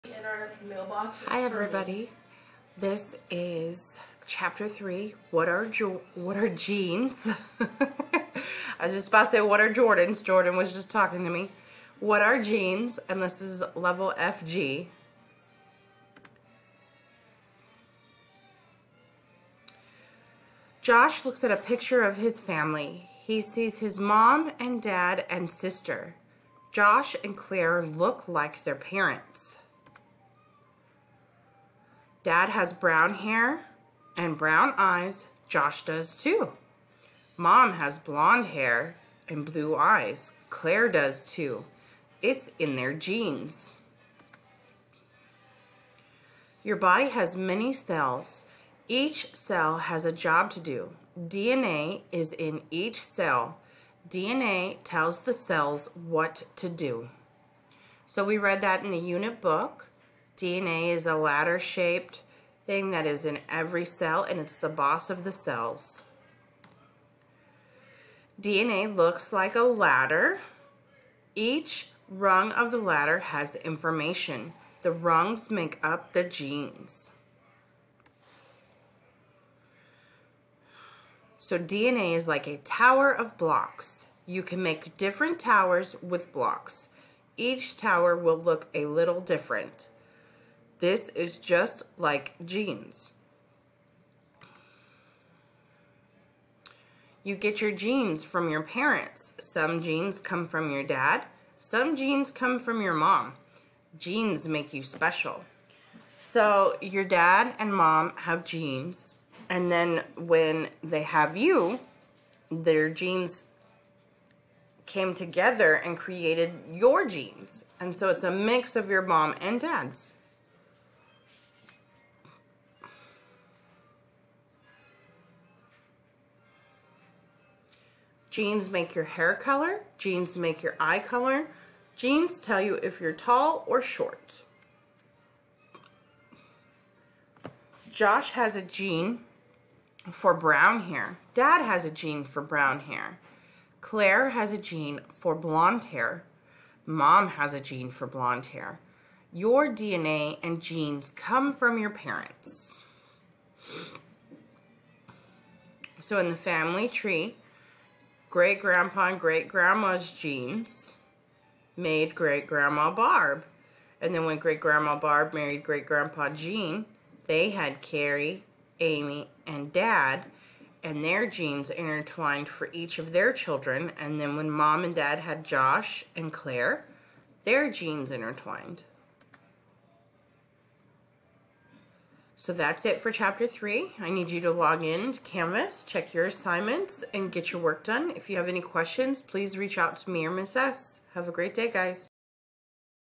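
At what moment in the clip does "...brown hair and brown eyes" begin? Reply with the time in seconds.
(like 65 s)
32 s.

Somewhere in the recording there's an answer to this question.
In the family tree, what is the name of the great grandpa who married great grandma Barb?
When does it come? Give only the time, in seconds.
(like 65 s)
165 s.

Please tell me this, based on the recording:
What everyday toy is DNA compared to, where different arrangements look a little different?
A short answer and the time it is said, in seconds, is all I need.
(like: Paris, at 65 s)
a tower of blocks, at 82 s.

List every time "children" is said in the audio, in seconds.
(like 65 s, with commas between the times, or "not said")
173 s.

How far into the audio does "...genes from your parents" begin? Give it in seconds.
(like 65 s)
97 s.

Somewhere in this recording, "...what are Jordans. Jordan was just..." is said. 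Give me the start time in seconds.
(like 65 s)
9 s.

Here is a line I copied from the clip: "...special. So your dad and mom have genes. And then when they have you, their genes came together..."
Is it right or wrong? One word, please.
right.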